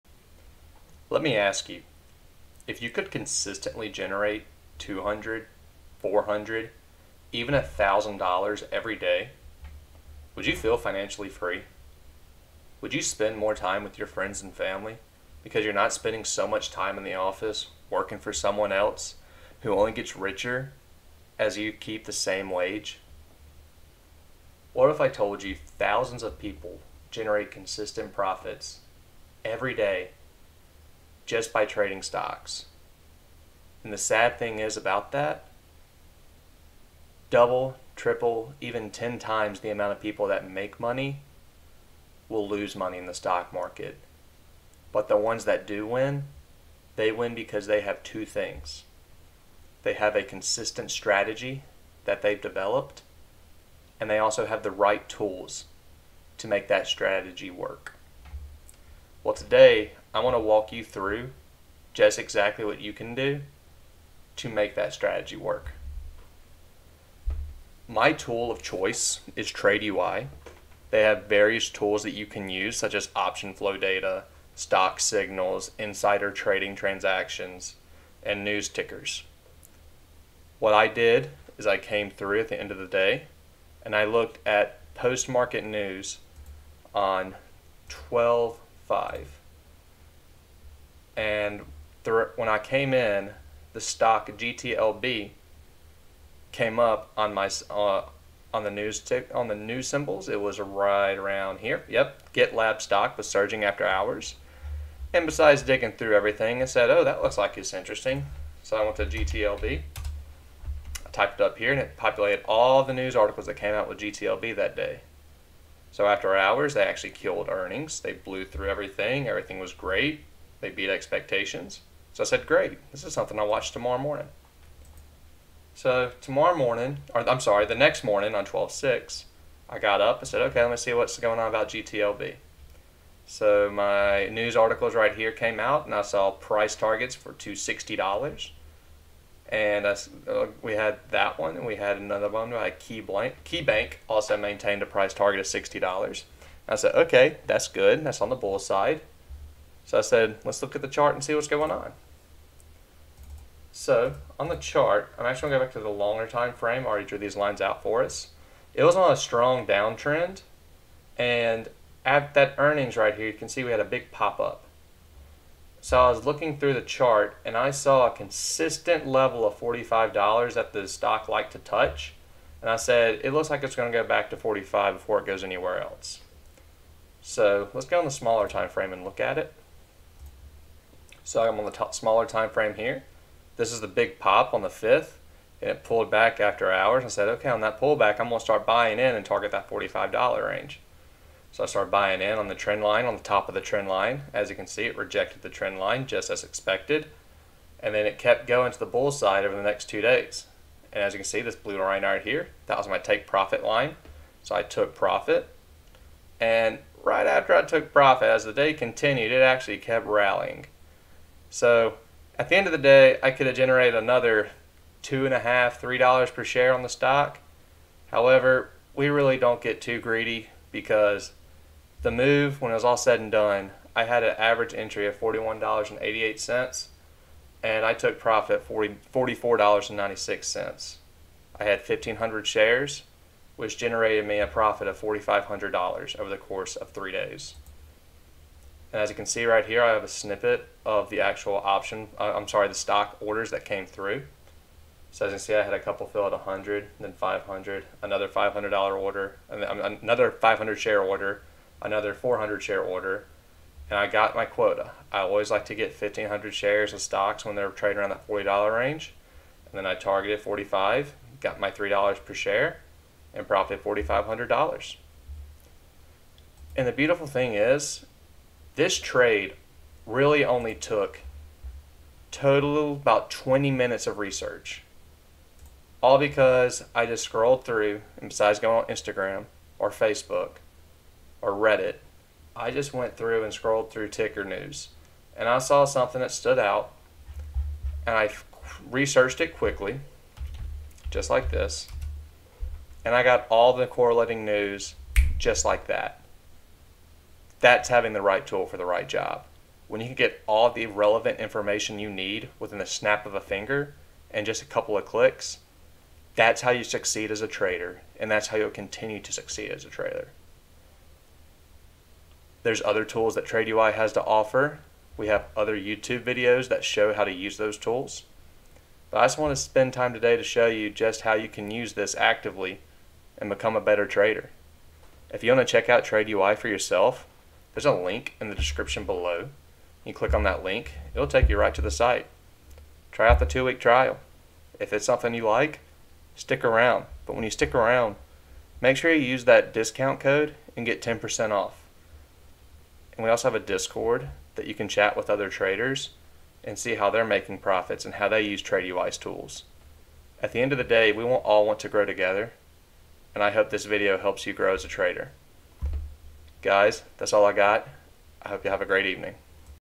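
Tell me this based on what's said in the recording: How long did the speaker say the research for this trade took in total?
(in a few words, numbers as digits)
20 minutes.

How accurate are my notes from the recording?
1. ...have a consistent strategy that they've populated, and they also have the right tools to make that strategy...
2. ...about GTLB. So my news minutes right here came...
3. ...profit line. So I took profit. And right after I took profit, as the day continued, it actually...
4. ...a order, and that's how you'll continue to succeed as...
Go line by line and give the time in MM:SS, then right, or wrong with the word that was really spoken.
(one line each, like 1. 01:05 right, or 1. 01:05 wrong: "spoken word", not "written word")
1. 00:49 wrong: "developed", not "populated"
2. 02:11 wrong: "articles", not "minutes"
3. 03:23 right
4. 05:07 wrong: "trader", not "order".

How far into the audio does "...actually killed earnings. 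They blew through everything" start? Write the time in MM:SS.
01:56.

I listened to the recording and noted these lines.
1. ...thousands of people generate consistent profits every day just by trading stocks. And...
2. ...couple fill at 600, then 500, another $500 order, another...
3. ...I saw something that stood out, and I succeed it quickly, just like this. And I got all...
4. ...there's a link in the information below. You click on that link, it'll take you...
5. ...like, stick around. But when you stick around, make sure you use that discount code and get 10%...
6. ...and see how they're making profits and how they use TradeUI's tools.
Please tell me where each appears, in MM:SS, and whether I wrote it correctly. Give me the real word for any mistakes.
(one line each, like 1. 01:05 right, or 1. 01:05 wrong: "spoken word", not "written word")
1. 00:25 right
2. 04:05 wrong: "100", not "600"
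3. 04:45 wrong: "researched", not "succeed"
4. 05:27 wrong: "description", not "information"
5. 05:35 right
6. 05:46 right.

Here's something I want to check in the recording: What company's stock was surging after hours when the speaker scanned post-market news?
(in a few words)
GitLab.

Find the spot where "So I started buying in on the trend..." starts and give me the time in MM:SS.
03:11.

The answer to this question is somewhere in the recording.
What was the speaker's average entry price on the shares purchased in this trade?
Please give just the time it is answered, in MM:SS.
03:45.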